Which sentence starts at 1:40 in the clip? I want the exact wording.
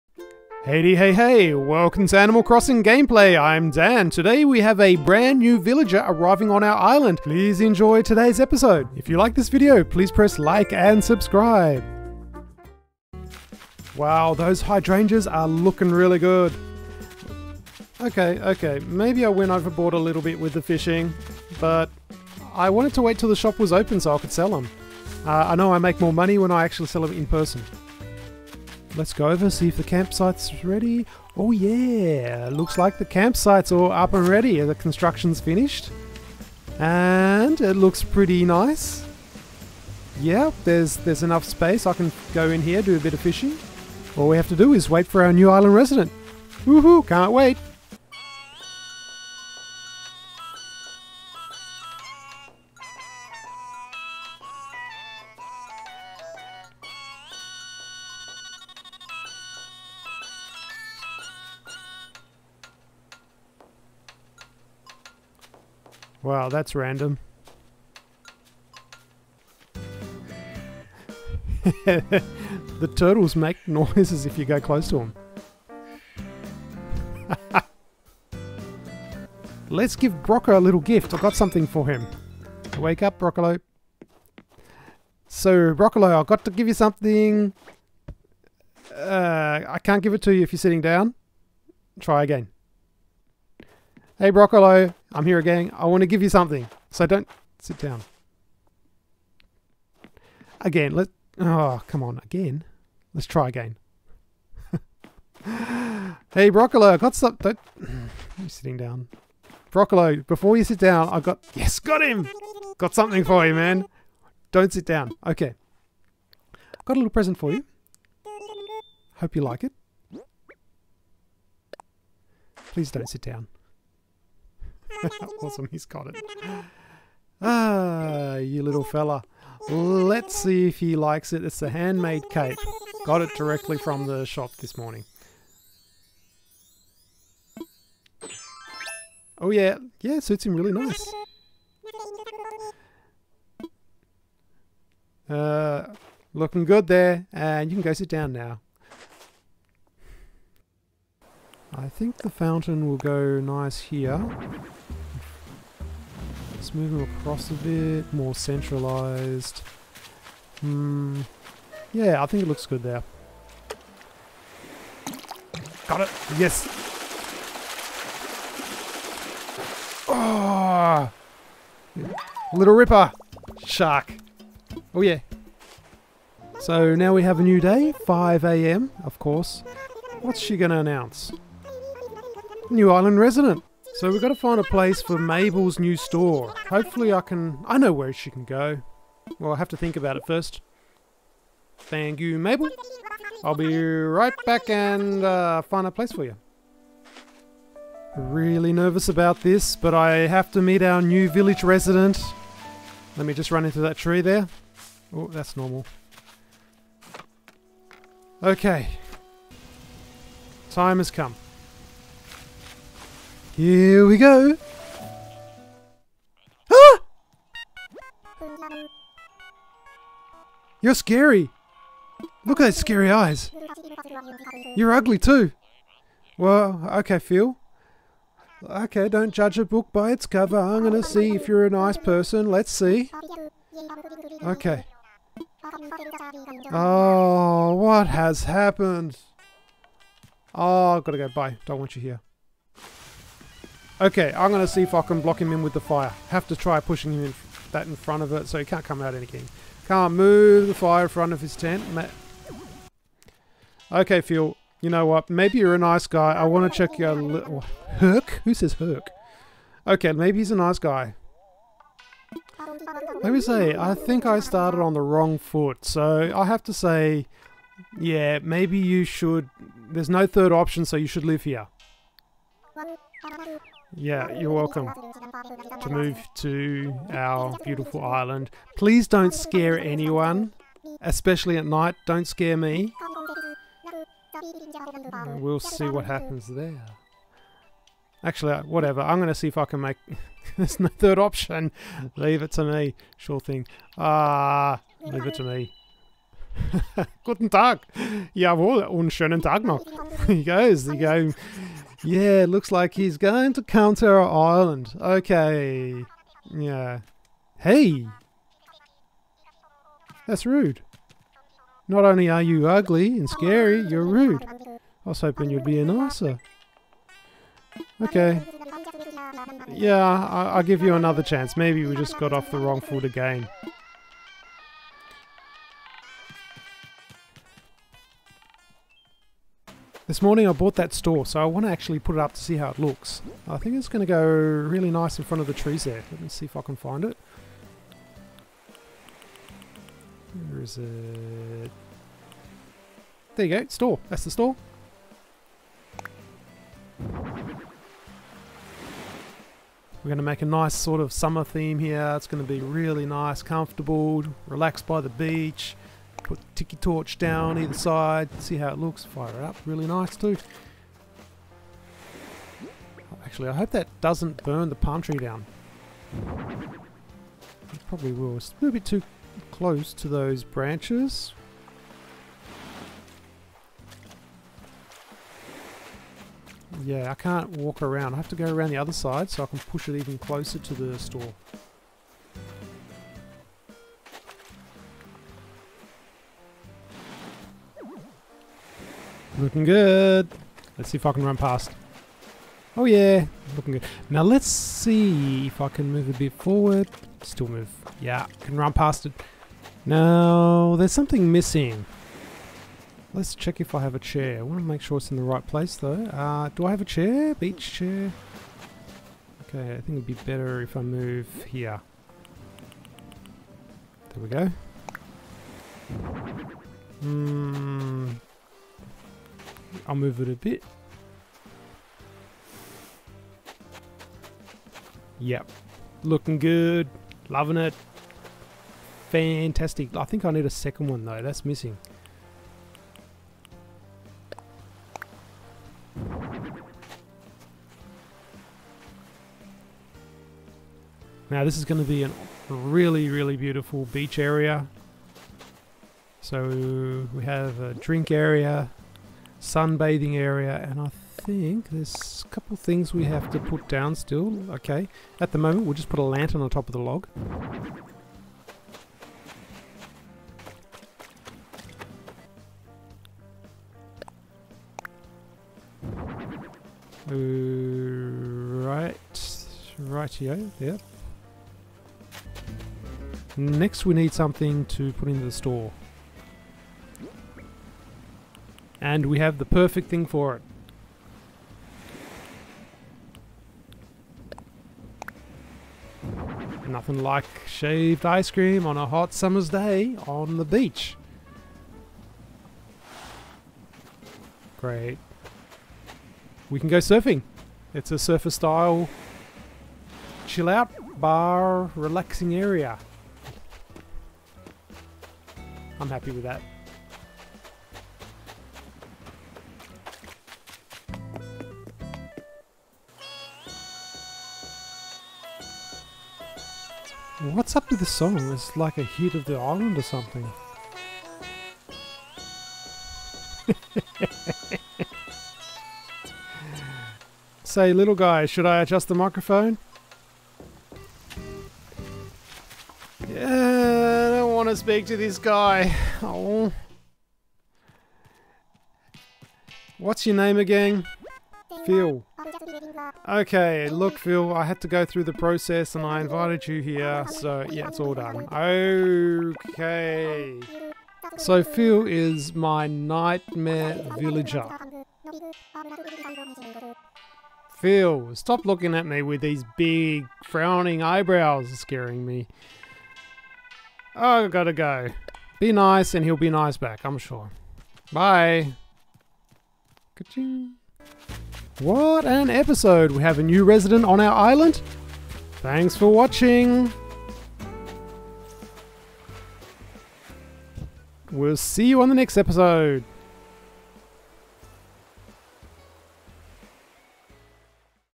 Again, let oh come on, again.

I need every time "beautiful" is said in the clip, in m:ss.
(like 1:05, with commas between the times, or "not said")
4:37, 7:23.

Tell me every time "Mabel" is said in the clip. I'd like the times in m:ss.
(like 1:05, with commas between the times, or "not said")
3:05, 3:12.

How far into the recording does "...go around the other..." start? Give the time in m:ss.
6:18.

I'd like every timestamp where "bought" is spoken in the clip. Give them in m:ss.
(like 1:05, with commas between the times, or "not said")
5:30.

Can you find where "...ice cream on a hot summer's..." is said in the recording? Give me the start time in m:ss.
8:08.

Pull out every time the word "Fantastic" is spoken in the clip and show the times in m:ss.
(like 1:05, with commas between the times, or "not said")
7:09.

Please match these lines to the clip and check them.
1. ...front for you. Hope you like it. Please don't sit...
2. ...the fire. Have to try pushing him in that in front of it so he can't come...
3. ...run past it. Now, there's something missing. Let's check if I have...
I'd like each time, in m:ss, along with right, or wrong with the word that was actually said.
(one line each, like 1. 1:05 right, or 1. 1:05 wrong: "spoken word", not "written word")
1. 1:57 wrong: "present", not "front"
2. 4:05 right
3. 6:38 right.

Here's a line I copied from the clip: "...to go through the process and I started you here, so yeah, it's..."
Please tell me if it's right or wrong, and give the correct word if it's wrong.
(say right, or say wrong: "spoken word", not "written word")
wrong: "invited", not "started".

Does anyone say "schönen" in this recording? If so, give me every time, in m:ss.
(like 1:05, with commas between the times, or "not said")
4:59.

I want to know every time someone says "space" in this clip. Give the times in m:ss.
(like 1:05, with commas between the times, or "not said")
0:41.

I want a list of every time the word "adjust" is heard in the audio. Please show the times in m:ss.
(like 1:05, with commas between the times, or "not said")
8:48.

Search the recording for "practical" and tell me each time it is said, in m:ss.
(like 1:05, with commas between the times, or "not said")
not said.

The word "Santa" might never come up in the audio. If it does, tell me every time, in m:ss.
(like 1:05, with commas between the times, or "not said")
not said.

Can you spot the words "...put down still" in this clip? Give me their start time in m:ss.
7:33.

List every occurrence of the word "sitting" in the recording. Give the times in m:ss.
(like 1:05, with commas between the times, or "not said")
1:30, 1:48.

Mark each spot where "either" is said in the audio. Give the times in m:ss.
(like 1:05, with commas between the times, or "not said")
5:57.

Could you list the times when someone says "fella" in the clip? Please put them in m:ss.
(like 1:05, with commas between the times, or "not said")
2:08.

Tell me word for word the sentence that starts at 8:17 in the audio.
It's a surfer style chill out bar relaxing area.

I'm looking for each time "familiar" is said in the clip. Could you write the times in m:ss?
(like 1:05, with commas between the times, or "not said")
not said.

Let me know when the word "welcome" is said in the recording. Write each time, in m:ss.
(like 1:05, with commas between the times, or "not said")
0:01, 4:34.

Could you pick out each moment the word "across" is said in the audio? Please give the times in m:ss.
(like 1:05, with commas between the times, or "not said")
2:37.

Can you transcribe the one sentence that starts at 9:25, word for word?
Be nice and he'll be nice back, I'm sure.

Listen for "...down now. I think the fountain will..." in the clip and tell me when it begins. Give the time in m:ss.
2:28.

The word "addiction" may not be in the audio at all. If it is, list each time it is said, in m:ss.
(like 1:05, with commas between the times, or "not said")
not said.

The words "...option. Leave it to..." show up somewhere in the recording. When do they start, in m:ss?
4:51.